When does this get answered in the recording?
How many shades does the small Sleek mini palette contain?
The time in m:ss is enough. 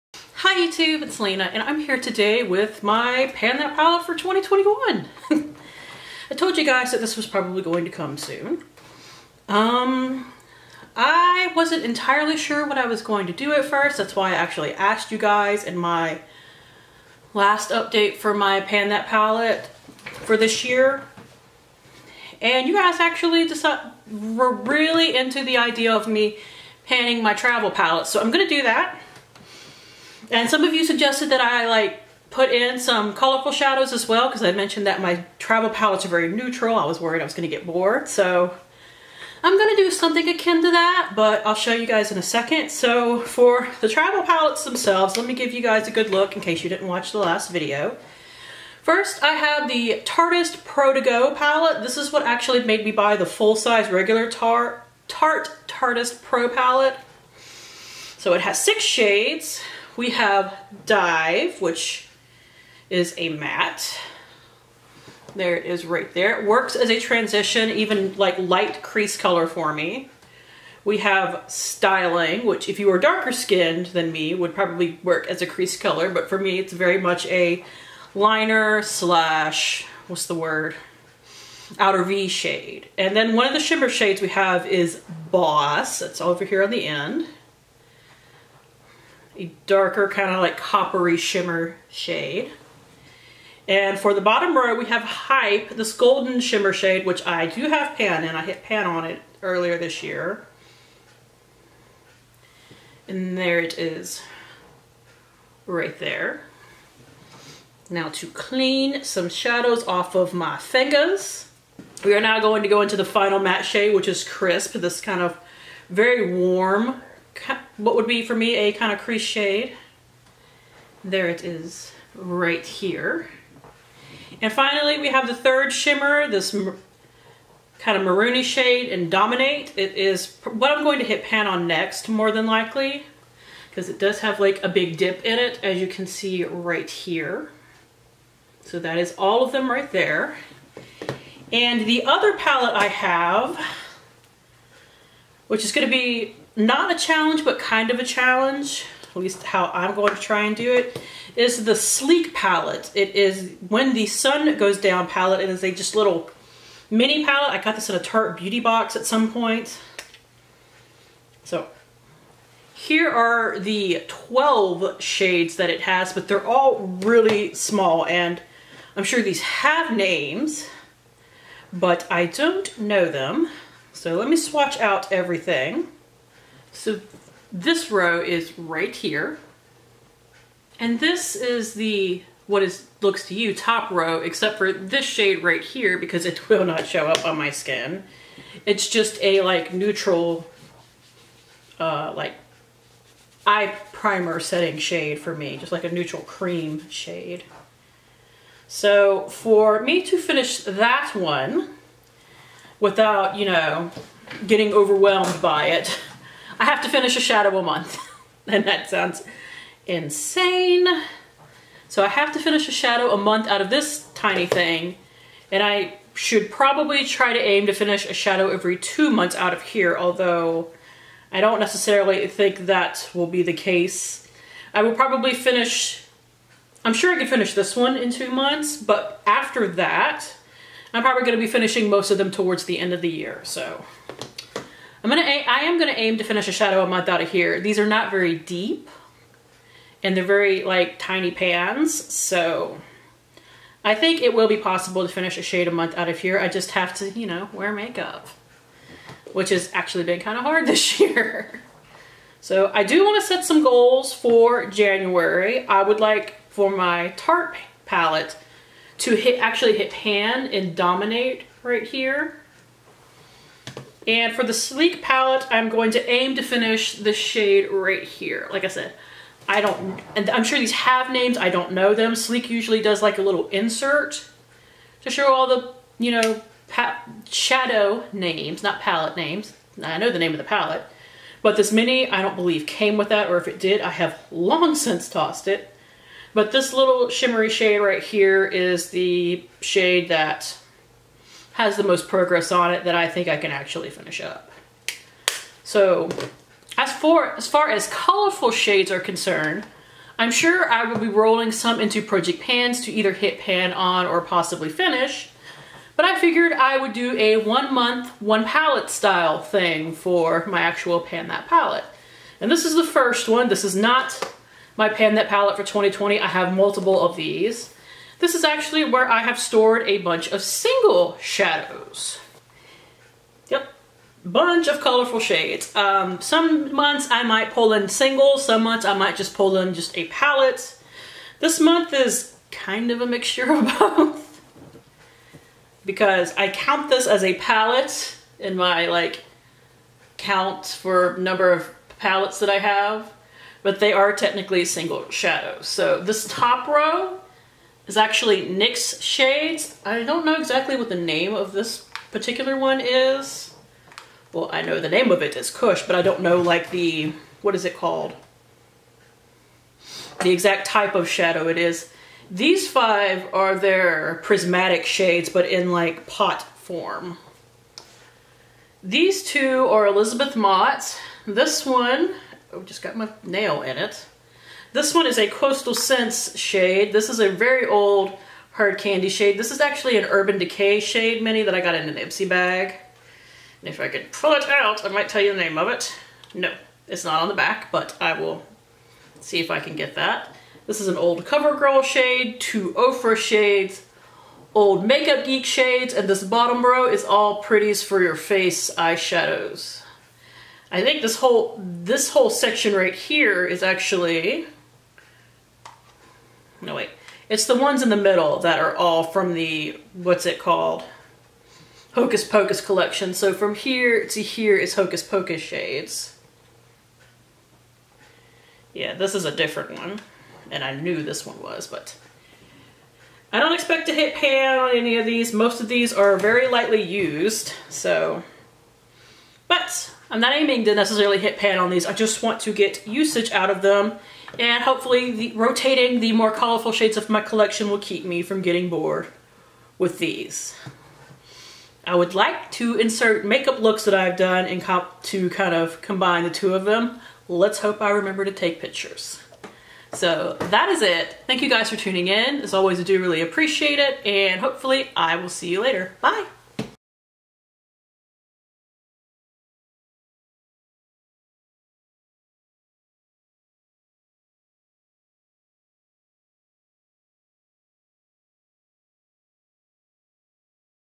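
2:44.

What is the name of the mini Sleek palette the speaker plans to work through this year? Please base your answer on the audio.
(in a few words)
When the Sun Goes Down.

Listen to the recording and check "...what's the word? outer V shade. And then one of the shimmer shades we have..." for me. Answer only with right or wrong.
right.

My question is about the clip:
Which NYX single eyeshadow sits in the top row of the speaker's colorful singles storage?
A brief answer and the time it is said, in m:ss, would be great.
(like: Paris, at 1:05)
Kush, at 5:55.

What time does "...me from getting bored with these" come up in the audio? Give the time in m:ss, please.
7:18.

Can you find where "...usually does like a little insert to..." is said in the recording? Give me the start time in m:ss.
4:32.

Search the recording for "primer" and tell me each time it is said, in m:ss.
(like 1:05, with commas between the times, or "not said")
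3:13.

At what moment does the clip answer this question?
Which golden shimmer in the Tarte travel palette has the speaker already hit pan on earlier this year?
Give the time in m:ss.
1:35.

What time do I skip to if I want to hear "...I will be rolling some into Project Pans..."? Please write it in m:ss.
5:00.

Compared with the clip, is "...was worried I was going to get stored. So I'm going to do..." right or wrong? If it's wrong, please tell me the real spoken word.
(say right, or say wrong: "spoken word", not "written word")
wrong: "bored", not "stored".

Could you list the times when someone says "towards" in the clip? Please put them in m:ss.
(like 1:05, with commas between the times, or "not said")
3:52.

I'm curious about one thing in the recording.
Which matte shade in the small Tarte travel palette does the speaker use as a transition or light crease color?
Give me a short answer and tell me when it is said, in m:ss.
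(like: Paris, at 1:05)
Dive, at 1:00.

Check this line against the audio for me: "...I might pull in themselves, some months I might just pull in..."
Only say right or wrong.
wrong.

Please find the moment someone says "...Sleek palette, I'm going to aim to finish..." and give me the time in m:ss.
4:24.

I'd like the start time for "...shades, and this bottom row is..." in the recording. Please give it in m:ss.
6:35.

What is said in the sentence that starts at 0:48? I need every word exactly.
First, I have the Tartist Pro To Go palette.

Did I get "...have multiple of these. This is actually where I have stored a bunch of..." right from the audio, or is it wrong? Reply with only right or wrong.
right.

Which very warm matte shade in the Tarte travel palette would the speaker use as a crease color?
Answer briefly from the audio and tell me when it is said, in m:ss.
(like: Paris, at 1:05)
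Crisp, at 1:54.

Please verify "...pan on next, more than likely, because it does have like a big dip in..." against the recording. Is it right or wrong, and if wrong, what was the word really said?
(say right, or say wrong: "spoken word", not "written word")
right.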